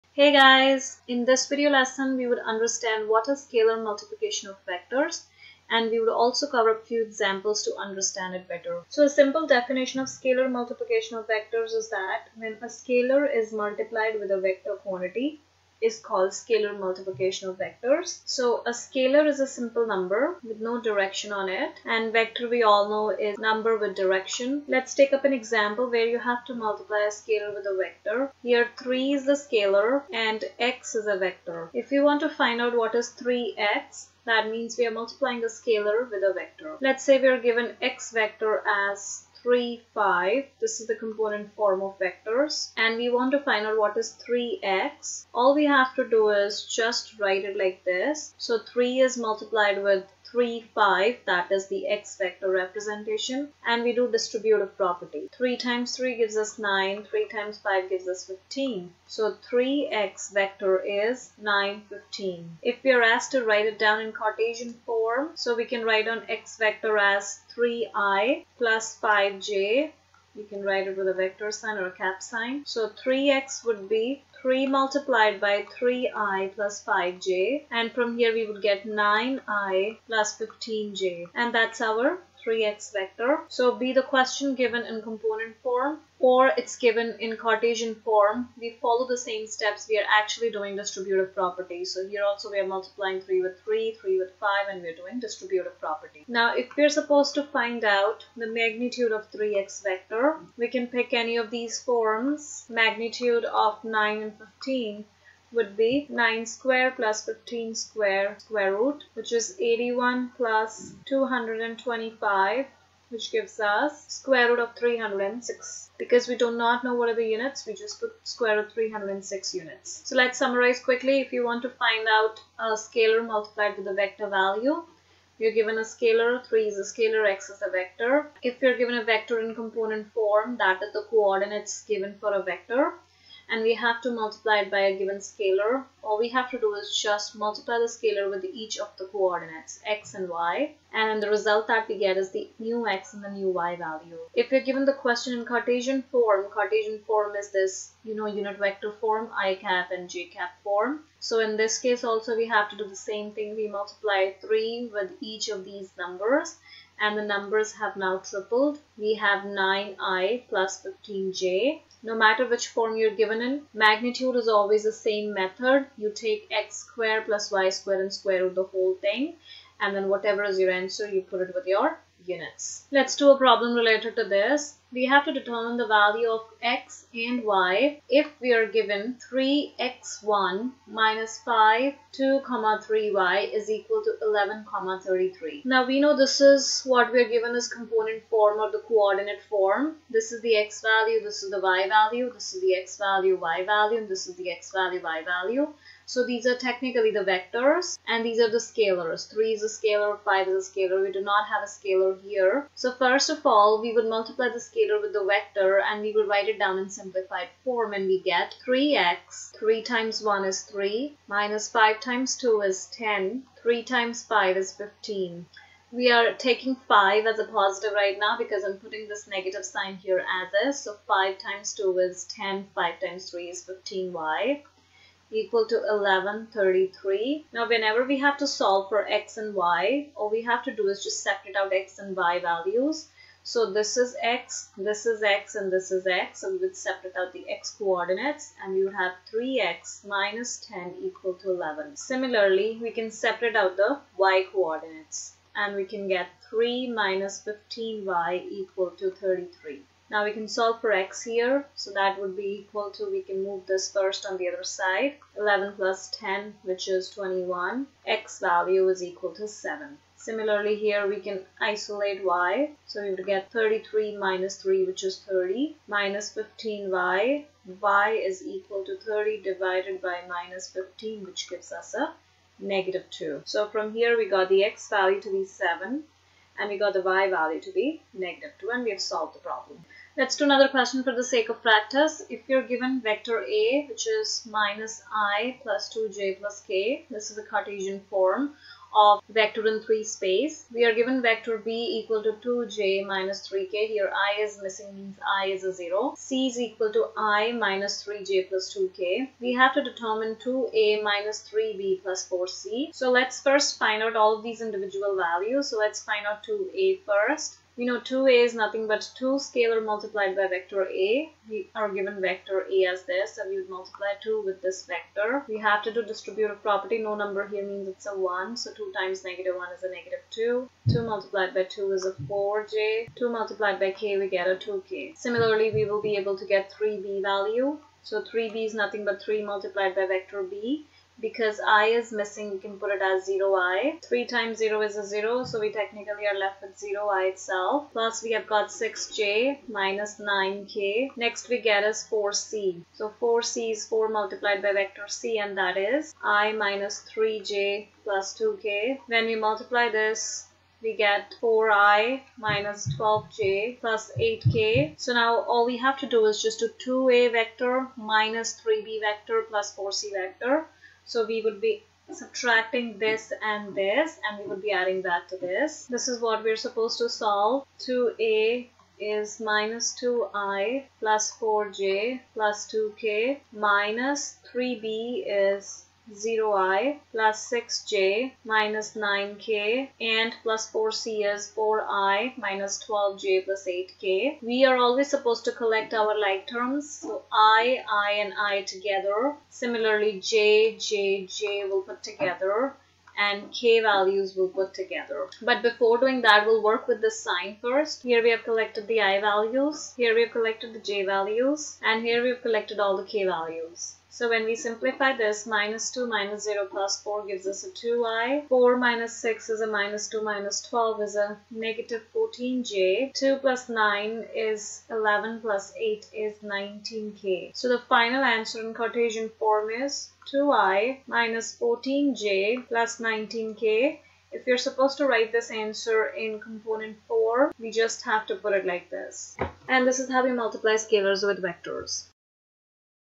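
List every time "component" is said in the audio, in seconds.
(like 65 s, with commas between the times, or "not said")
40 s, 85 s, 129 s, 187 s, 426 s.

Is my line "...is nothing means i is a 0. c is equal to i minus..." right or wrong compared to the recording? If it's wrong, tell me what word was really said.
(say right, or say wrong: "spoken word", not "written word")
wrong: "missing", not "nothing".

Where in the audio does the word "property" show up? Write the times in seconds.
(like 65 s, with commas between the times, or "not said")
54 s, 91 s, 95 s, 316 s.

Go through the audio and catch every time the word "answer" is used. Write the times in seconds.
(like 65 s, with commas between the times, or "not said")
170 s, 418 s, 425 s.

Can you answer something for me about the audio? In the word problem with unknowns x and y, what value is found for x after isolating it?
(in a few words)
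7.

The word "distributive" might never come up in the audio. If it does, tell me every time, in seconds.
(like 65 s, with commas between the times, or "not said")
54 s, 90 s, 95 s, 316 s.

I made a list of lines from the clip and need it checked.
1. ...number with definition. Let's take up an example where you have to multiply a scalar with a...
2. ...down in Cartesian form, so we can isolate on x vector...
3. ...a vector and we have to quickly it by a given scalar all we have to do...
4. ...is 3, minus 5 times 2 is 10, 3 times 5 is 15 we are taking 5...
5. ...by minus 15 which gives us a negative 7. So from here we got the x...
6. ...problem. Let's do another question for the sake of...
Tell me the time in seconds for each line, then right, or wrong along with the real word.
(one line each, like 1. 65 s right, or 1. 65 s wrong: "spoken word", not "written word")
1. 23 s wrong: "direction", not "definition"
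2. 63 s wrong: "write", not "isolate"
3. 132 s wrong: "multiply", not "quickly"
4. 210 s right
5. 270 s wrong: "2", not "7"
6. 279 s right.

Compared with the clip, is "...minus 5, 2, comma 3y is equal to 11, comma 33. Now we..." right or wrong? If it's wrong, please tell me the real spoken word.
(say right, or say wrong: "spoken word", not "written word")
right.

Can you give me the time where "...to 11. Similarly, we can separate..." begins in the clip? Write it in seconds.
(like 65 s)
241 s.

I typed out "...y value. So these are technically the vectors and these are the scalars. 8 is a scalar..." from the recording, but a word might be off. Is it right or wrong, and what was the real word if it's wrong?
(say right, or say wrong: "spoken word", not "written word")
wrong: "3", not "8".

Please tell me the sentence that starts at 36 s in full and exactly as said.
Let's say we are given x vector as 3, 5.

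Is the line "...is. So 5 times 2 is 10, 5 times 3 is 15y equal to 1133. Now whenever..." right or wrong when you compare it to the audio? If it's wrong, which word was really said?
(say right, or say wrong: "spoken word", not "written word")
right.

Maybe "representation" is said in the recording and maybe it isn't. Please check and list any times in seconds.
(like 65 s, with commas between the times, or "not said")
52 s.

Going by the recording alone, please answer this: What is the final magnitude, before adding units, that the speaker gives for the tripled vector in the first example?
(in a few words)
square root of 306.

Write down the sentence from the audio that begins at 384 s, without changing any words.
We are always supposed to collect our like terms.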